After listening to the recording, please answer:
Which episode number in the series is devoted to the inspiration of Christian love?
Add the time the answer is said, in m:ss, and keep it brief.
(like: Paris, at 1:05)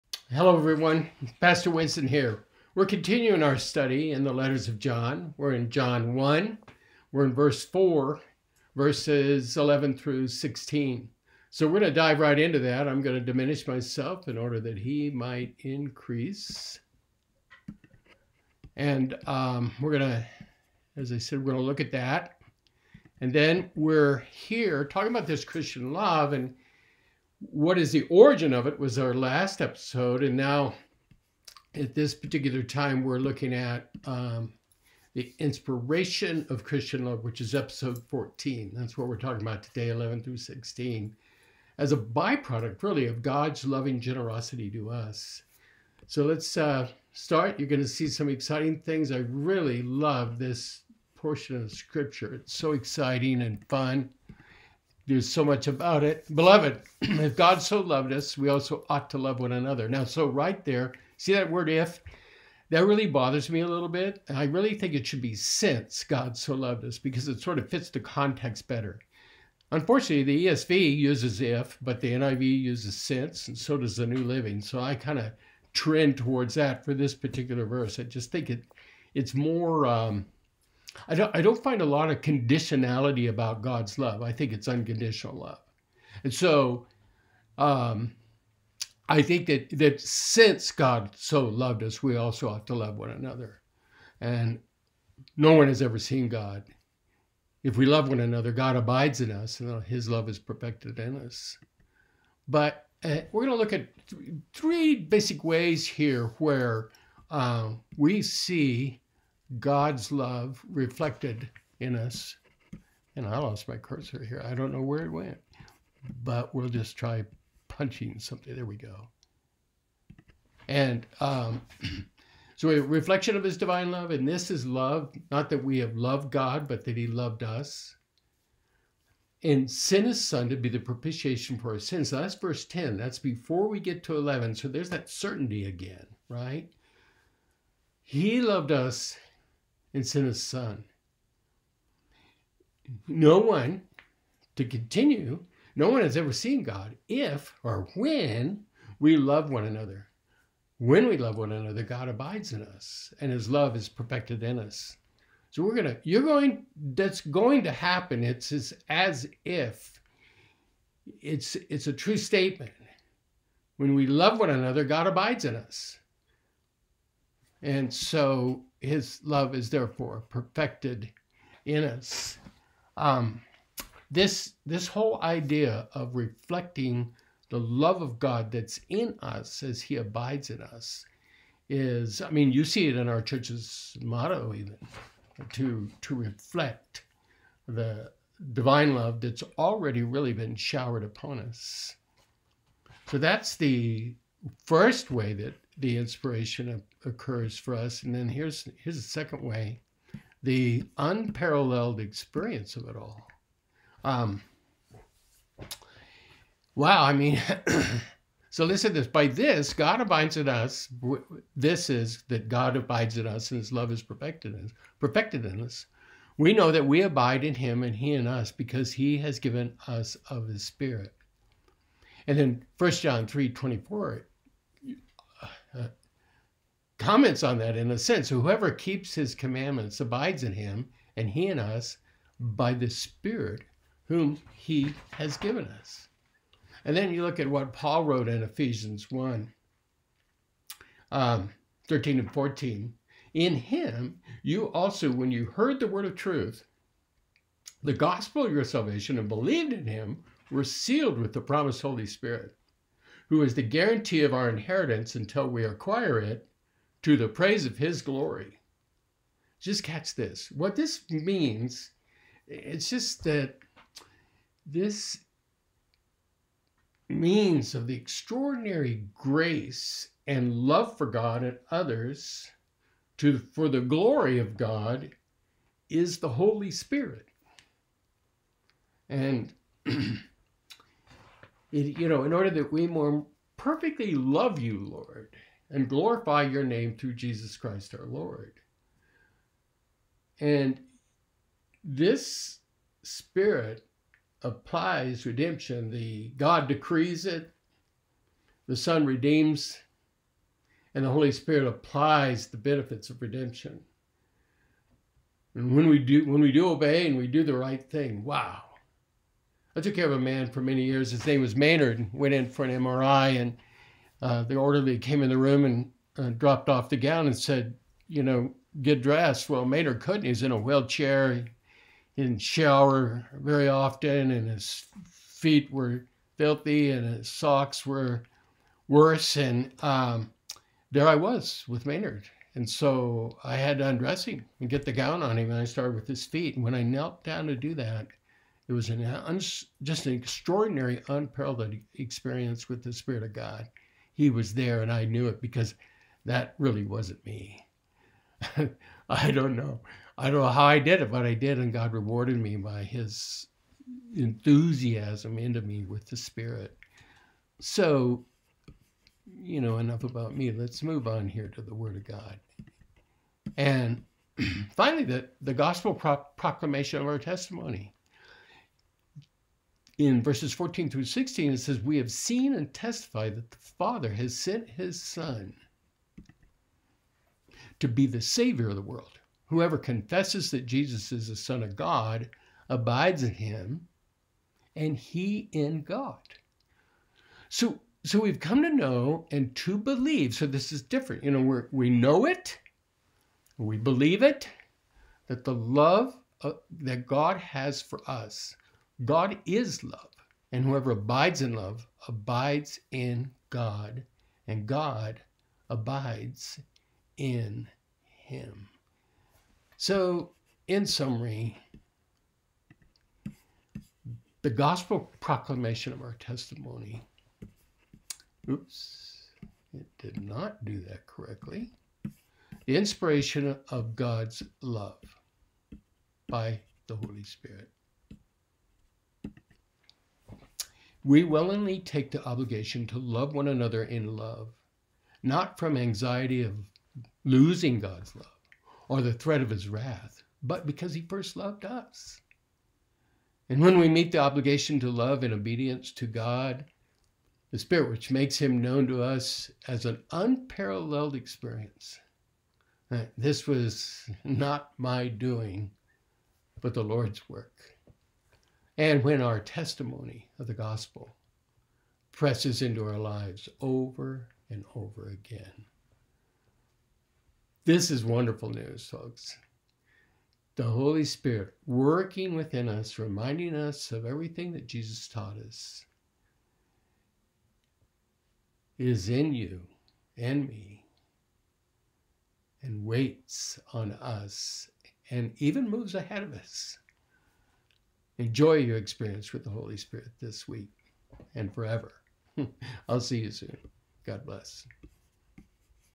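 14, at 0:37.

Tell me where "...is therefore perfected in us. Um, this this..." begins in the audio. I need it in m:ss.
2:49.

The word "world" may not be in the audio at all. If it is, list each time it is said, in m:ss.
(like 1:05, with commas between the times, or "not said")
6:18.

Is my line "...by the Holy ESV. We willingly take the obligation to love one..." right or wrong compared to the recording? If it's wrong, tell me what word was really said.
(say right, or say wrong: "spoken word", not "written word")
wrong: "Spirit", not "ESV".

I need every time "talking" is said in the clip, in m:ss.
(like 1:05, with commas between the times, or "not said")
0:24, 0:39.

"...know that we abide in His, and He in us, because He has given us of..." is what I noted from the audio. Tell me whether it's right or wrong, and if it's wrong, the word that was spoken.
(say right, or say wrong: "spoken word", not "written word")
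wrong: "Him", not "His".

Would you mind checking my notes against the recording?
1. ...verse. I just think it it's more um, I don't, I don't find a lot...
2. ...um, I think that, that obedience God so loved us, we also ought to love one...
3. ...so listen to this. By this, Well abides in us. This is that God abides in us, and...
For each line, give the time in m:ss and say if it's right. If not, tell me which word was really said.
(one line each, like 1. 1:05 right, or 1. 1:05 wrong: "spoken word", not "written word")
1. 1:17 right
2. 1:27 wrong: "since", not "obedience"
3. 3:28 wrong: "God", not "Well".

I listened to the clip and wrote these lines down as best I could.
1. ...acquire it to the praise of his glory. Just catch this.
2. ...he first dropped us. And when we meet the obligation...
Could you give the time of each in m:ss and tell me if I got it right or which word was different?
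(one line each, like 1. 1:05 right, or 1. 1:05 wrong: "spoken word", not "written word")
1. 4:15 right
2. 7:20 wrong: "loved", not "dropped".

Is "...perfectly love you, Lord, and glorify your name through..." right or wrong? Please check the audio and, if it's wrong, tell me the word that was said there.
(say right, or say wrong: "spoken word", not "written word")
right.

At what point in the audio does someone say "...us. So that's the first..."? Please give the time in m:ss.
3:11.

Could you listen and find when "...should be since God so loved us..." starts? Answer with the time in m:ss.
1:05.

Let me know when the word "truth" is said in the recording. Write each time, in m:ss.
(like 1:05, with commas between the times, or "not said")
4:06.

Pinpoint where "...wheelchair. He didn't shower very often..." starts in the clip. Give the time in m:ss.
5:20.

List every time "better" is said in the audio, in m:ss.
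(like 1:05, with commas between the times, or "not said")
1:08.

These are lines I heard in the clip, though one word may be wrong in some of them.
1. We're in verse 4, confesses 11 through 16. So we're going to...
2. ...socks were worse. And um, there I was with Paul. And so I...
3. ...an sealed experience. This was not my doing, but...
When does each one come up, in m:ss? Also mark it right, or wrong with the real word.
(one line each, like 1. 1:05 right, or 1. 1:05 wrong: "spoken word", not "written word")
1. 0:07 wrong: "verses", not "confesses"
2. 5:27 wrong: "Maynard", not "Paul"
3. 7:29 wrong: "unparalleled", not "sealed".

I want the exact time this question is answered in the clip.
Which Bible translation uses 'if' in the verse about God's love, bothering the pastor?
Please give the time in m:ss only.
1:10.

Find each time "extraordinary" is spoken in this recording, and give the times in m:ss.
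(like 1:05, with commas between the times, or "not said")
4:27, 5:40.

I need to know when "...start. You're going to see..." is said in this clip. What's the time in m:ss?
0:47.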